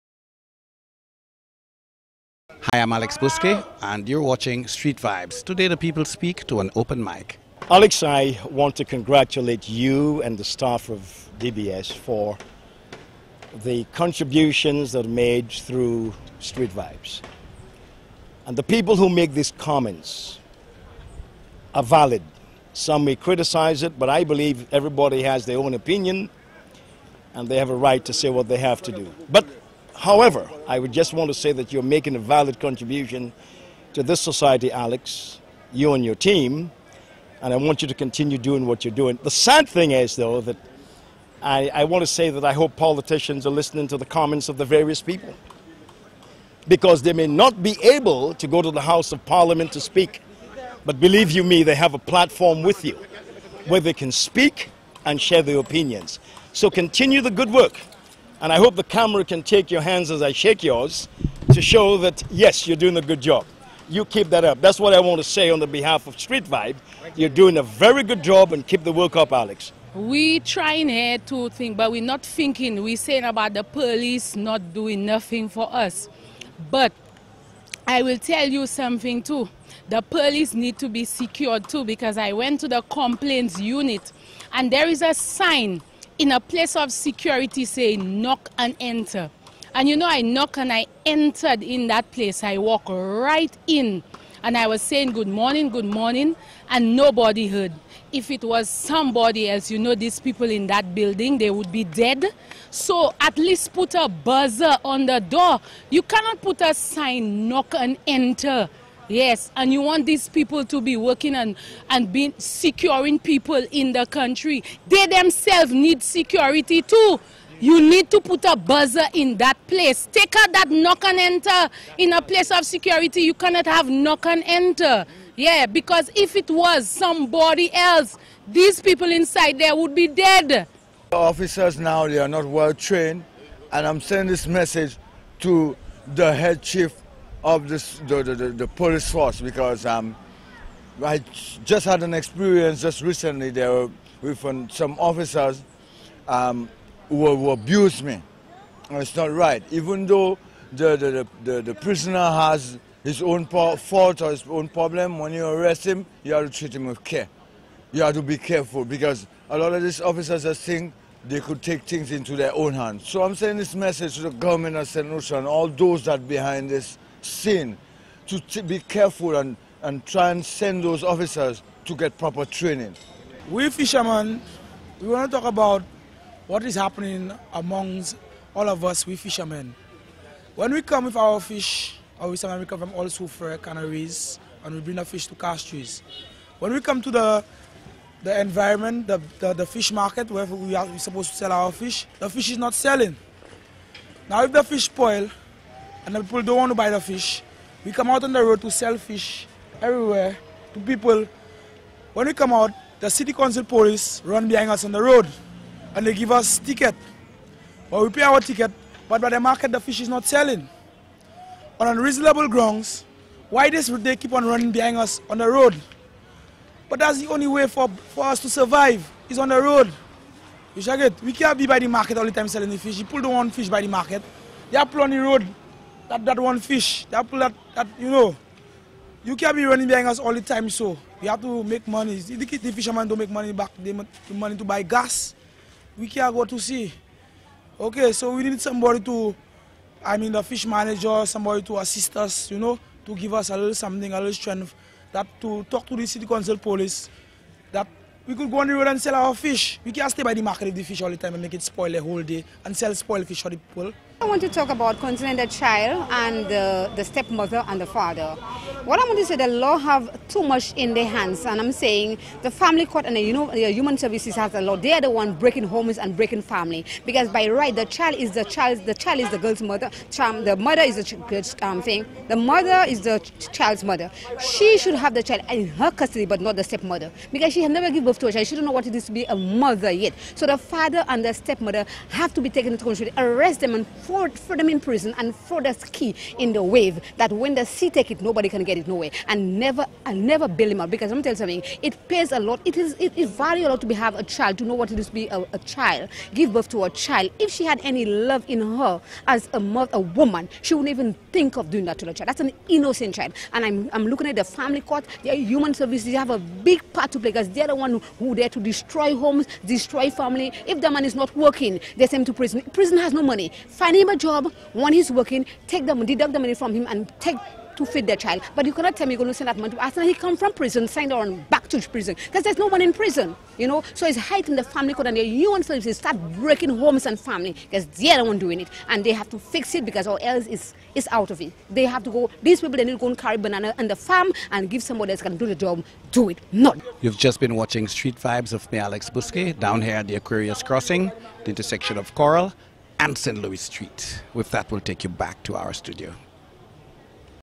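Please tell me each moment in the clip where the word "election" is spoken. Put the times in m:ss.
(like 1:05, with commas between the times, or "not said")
not said.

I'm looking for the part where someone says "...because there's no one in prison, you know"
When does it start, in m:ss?
5:22.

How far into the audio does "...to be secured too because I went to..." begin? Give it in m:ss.
1:20.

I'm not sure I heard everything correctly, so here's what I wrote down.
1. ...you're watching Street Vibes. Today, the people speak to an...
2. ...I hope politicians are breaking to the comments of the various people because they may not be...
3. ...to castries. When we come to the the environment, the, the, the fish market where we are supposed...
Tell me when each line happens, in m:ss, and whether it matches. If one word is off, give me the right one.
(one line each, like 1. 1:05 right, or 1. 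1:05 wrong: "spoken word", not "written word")
1. 0:04 right
2. 0:42 wrong: "listening", not "breaking"
3. 3:05 right.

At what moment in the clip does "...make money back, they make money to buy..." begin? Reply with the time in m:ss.
3:53.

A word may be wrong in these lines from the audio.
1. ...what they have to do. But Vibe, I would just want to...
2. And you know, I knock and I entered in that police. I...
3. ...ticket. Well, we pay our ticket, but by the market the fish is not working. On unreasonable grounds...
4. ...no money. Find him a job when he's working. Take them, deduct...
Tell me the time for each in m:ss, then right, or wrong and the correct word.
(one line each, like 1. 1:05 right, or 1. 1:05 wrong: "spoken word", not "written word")
1. 0:28 wrong: "However", not "Vibe"
2. 1:29 wrong: "place", not "police"
3. 3:26 wrong: "selling", not "working"
4. 5:13 right.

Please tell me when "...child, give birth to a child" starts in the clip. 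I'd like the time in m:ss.
4:55.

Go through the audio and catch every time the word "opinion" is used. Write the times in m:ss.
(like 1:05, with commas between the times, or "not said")
0:25, 0:55.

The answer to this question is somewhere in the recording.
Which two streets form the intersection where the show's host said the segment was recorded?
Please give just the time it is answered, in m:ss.
5:42.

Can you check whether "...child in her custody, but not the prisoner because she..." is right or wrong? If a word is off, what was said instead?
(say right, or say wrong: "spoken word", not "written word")
wrong: "stepmother", not "prisoner".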